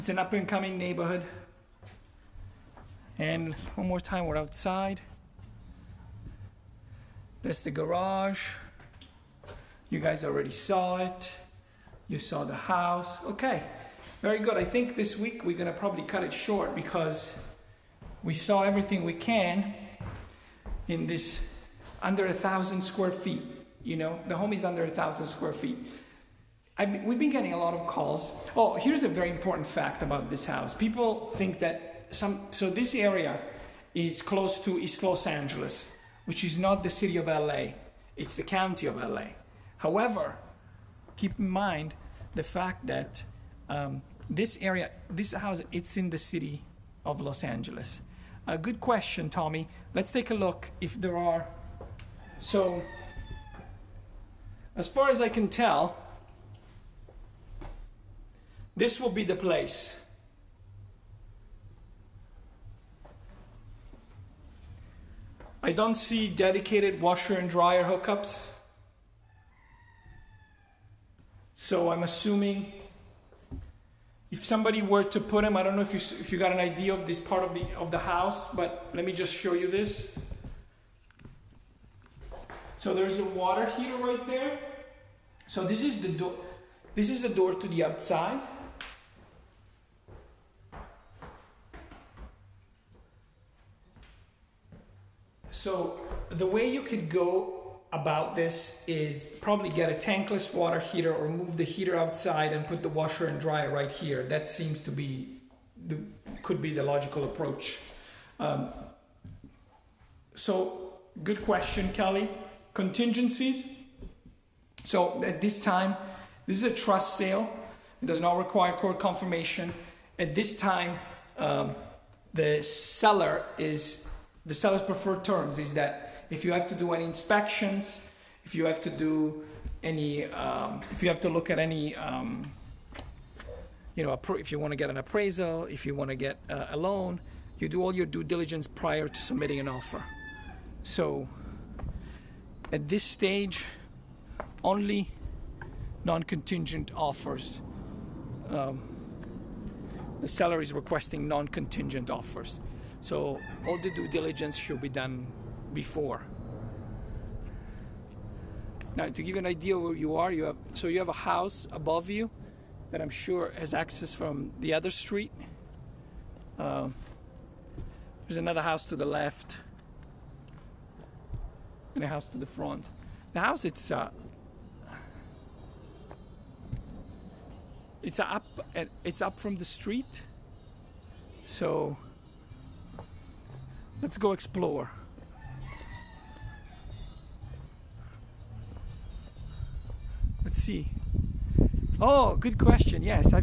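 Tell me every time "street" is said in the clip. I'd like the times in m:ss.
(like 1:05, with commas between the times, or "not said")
2:44, 2:59.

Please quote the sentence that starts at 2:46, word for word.
Uh, there's another house to the left and a house to the front.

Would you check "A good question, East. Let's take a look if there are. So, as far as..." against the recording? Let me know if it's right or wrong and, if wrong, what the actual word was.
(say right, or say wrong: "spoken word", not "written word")
wrong: "Tommy", not "East".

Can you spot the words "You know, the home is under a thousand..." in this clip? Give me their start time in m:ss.
0:23.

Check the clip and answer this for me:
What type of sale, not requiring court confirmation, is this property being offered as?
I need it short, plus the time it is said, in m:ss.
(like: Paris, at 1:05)
Trust sale, at 1:56.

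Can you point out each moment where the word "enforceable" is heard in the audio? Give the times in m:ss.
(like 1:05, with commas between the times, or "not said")
not said.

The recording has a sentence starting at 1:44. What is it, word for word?
That seems to be the could be the logical approach.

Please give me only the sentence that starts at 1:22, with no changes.
So there's a water heater right there.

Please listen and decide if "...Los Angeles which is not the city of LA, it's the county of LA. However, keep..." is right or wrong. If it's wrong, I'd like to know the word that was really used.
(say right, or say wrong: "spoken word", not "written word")
right.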